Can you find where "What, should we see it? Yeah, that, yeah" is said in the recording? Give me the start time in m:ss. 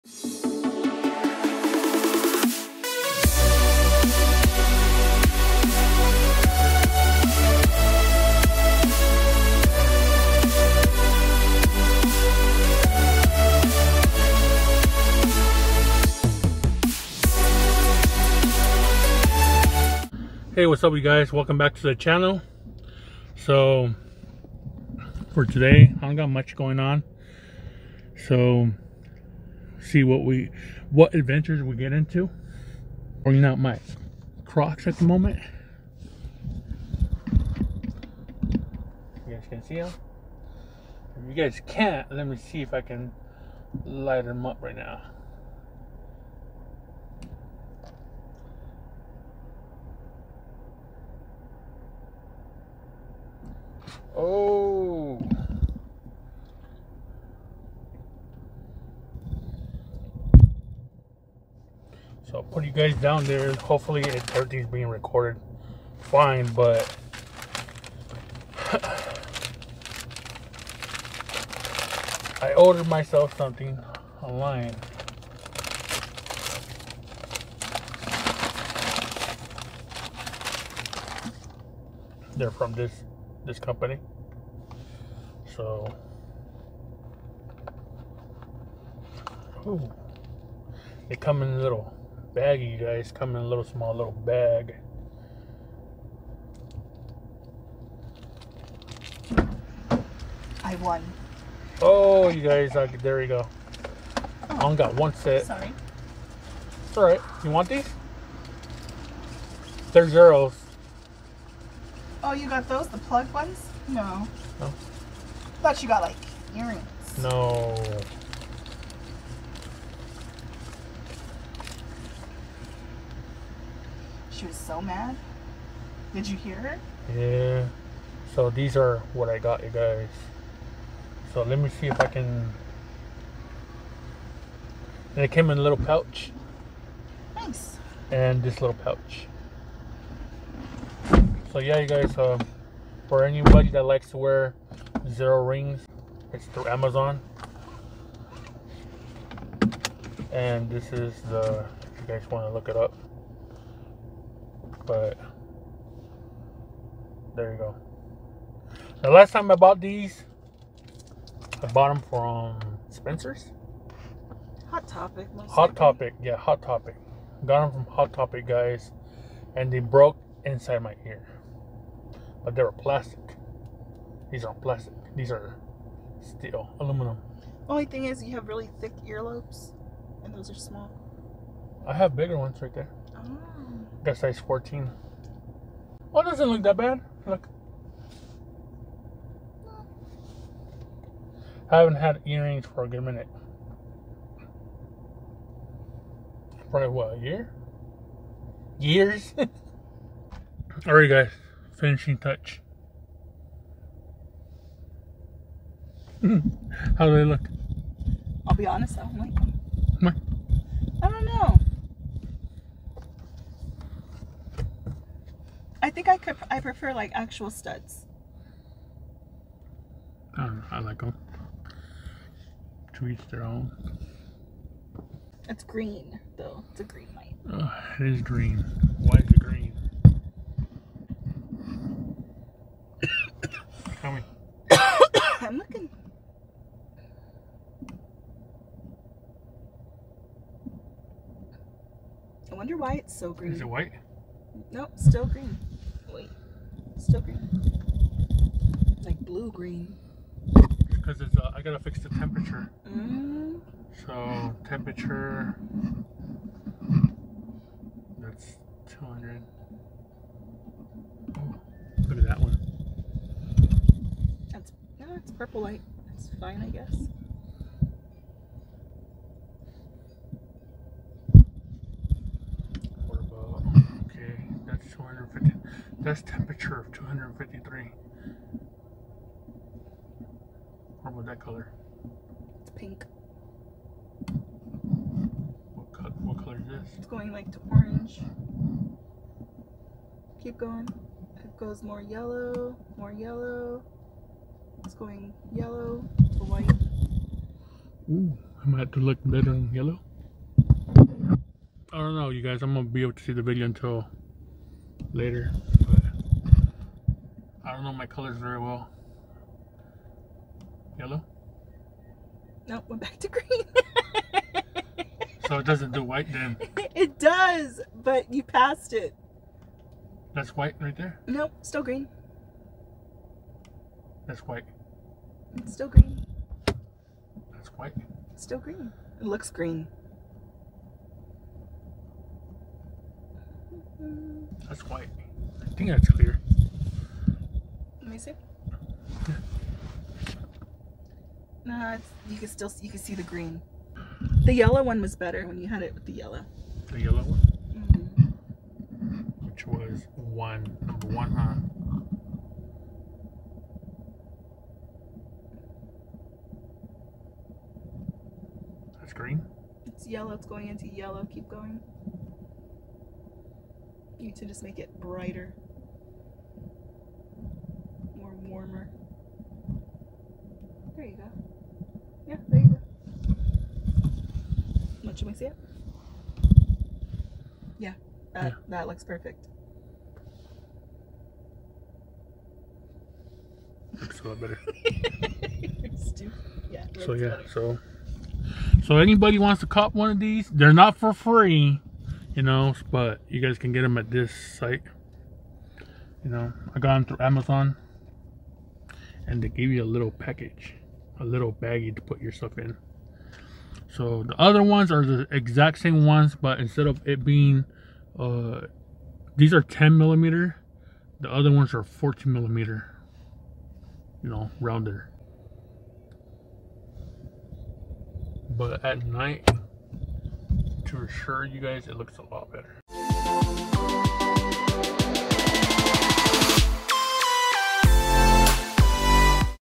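6:15.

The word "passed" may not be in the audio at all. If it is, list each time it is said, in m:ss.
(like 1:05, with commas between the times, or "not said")
5:18.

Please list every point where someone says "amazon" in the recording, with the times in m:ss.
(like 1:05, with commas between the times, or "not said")
2:26, 6:37.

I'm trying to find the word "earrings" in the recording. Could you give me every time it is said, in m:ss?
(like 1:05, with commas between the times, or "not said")
1:56, 3:12.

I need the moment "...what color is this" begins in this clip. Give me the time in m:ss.
4:46.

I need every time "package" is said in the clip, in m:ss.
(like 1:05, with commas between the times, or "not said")
6:40.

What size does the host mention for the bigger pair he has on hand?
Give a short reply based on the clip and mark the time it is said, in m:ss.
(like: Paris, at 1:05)
14, at 3:04.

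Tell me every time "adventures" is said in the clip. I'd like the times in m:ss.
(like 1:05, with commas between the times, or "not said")
0:31.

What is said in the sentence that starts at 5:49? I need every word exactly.
Which was one, number one, huh?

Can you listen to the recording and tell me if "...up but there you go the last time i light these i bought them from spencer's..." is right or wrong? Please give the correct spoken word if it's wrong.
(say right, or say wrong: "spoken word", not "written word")
wrong: "bought", not "light".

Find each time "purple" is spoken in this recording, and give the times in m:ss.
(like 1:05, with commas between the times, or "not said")
4:25.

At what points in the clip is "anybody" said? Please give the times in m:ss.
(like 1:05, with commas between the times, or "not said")
2:23, 6:28.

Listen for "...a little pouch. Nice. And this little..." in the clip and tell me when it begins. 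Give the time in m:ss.
2:15.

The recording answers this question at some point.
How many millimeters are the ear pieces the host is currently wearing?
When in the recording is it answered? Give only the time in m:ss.
6:49.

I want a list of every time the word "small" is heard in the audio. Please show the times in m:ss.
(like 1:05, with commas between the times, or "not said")
1:33, 3:00.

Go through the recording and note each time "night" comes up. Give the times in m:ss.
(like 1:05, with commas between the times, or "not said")
6:59.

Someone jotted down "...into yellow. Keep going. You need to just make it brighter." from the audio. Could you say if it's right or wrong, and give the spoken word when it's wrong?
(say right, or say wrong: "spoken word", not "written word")
right.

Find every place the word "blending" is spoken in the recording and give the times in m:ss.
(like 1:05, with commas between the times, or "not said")
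not said.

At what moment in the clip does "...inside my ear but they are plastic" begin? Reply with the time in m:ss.
2:50.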